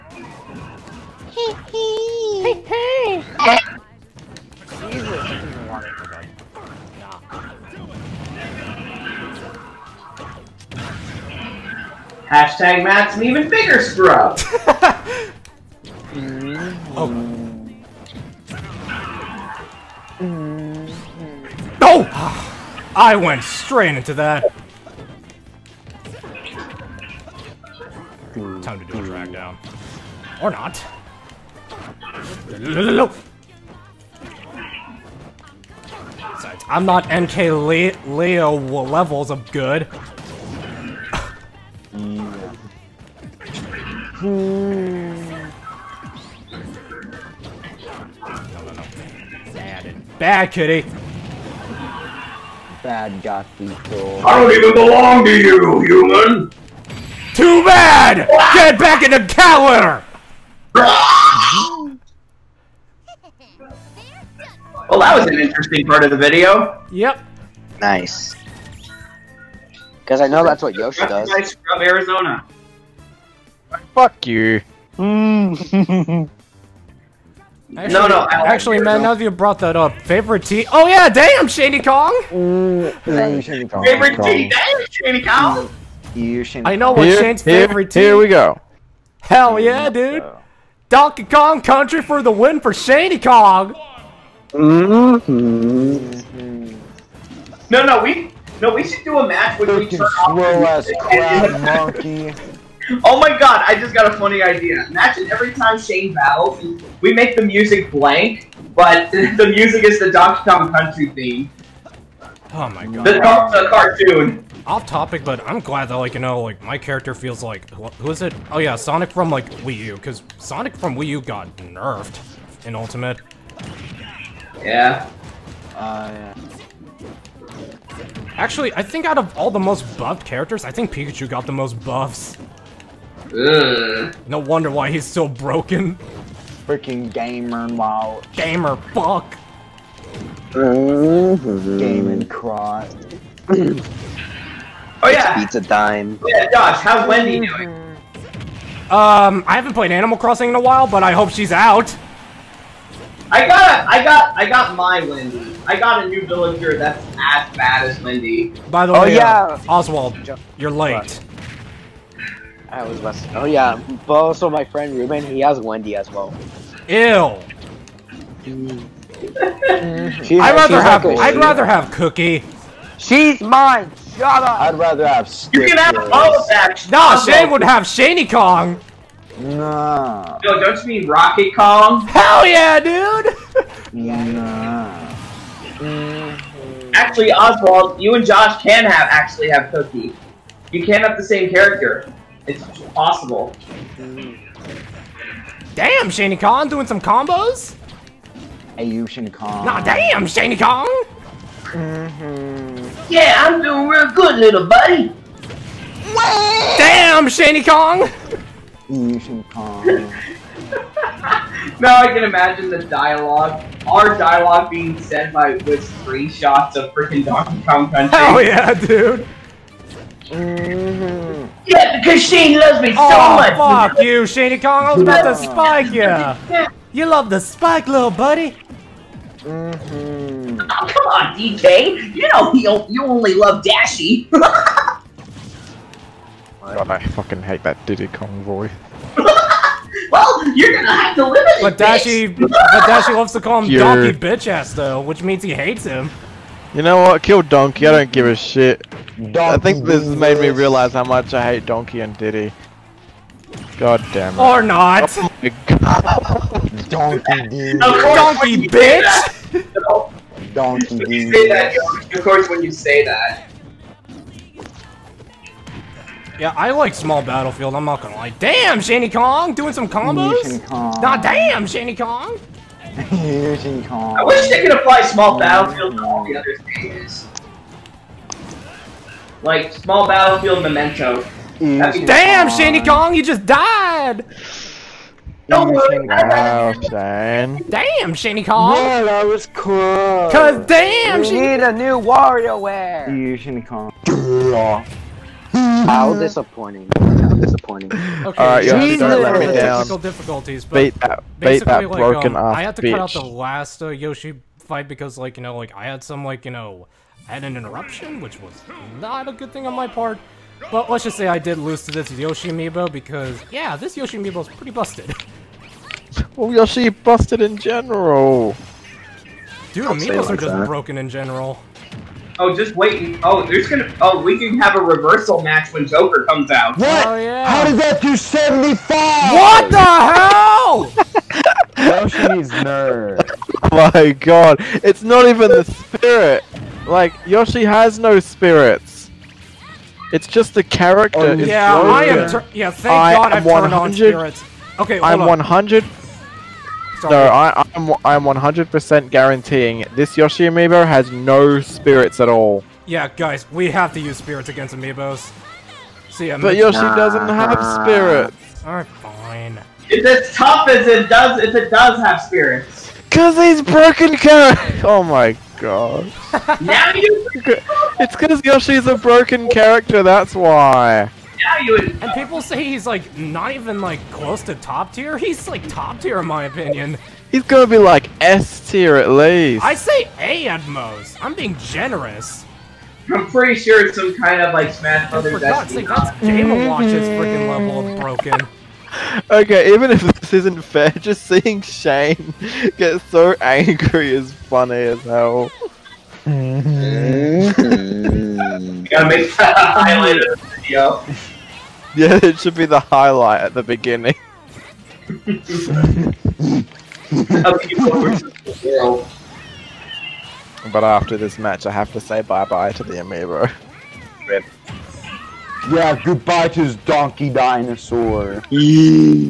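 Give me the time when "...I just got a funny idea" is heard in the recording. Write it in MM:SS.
01:43.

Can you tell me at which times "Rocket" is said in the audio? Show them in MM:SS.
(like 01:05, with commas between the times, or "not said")
03:01.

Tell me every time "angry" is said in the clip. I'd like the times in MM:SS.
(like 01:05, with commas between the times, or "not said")
06:33.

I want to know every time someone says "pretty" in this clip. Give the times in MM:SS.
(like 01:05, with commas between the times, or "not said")
05:14, 06:23.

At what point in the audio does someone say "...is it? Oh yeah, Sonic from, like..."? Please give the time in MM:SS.
01:58.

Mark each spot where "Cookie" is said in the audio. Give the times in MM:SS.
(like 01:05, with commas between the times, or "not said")
02:51, 03:09.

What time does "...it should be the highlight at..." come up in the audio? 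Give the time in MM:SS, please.
06:42.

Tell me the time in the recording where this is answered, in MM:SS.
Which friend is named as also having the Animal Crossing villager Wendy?
02:44.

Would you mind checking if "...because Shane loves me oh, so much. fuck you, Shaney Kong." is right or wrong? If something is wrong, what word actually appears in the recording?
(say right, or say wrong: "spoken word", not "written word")
right.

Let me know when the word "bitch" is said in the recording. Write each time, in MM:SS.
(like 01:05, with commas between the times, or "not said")
04:04, 04:18, 05:02.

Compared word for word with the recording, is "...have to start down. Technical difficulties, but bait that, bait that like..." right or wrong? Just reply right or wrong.
right.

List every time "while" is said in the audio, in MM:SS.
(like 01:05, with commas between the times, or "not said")
02:30.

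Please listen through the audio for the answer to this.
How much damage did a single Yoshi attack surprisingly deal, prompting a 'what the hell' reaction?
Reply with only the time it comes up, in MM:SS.
05:28.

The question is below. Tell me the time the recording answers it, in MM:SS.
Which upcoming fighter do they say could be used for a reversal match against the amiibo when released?
05:25.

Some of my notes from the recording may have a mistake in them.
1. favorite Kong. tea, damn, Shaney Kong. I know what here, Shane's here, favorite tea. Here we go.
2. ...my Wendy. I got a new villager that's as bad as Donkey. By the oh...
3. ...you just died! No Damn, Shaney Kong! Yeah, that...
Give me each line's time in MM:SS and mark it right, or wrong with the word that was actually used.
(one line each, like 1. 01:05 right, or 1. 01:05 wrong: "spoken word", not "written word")
1. 01:23 right
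2. 02:34 wrong: "Wendy", not "Donkey"
3. 04:43 right.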